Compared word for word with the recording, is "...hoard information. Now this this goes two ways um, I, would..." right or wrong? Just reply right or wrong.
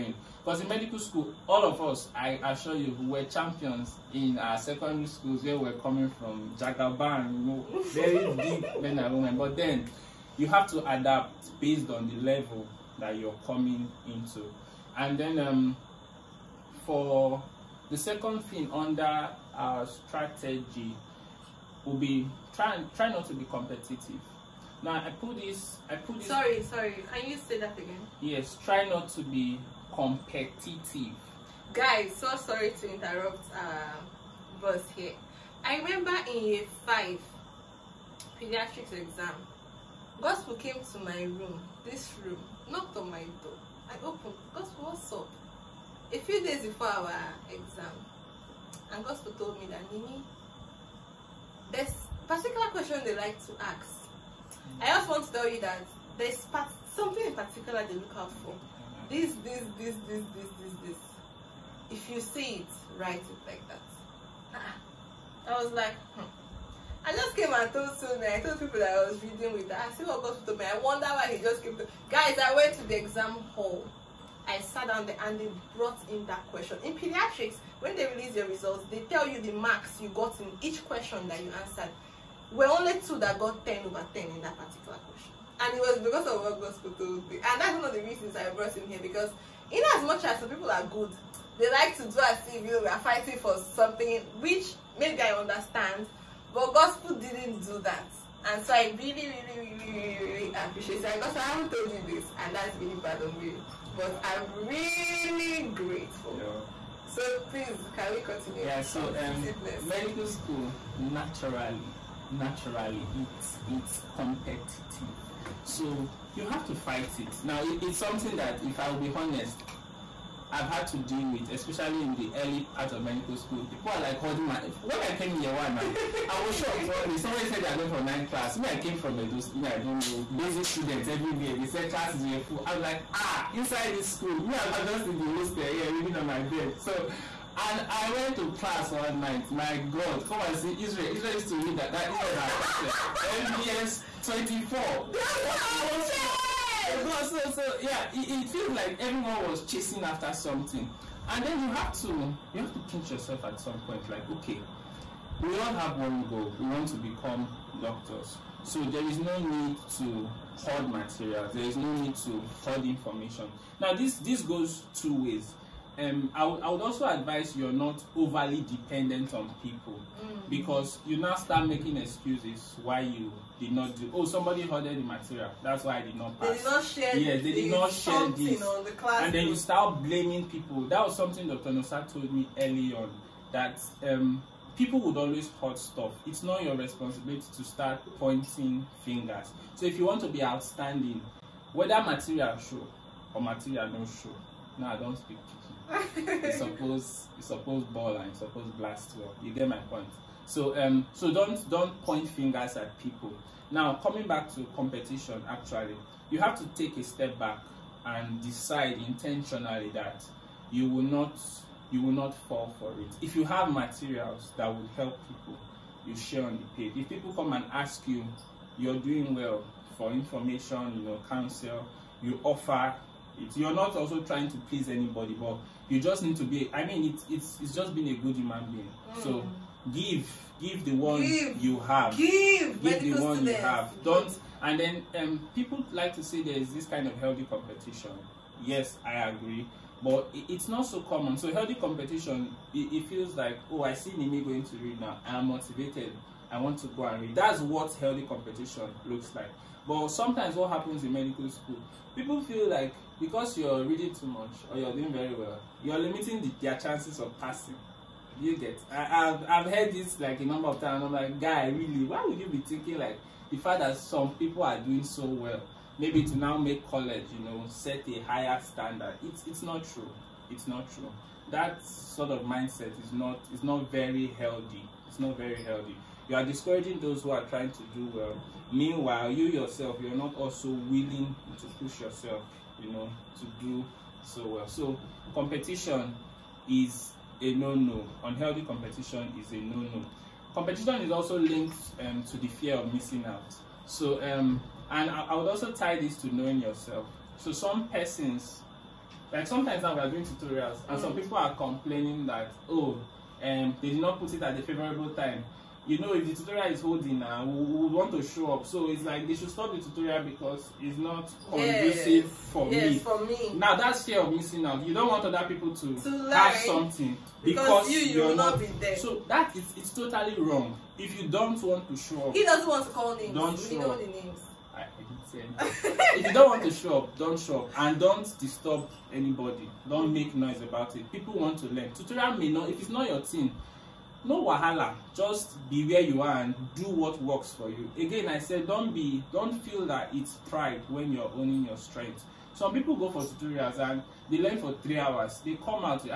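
right.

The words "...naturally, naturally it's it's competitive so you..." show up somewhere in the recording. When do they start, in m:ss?
1:50.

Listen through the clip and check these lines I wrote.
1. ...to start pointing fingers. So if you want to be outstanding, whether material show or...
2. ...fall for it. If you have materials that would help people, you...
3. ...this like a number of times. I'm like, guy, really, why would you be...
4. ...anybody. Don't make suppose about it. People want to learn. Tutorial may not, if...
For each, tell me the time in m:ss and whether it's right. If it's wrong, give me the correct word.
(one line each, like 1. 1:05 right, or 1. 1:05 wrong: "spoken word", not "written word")
1. 3:07 right
2. 3:32 right
3. 4:19 right
4. 5:29 wrong: "noise", not "suppose".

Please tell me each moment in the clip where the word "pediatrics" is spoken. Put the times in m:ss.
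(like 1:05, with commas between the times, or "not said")
0:38, 1:16.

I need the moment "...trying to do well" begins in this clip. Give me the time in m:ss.
4:37.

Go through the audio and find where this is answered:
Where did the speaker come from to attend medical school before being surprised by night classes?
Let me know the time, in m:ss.
2:09.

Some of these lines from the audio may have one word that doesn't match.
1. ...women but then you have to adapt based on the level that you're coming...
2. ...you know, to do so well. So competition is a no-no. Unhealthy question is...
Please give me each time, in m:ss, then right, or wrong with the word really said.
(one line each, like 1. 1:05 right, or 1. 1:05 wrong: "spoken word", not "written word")
1. 0:09 right
2. 4:42 wrong: "competition", not "question".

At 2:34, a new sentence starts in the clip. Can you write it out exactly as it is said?
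Like okay, we all have one goal.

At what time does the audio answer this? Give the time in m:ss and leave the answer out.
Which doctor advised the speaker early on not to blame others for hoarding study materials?
3:01.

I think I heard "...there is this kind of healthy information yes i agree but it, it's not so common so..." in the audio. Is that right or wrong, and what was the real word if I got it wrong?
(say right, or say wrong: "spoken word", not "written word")
wrong: "competition", not "information".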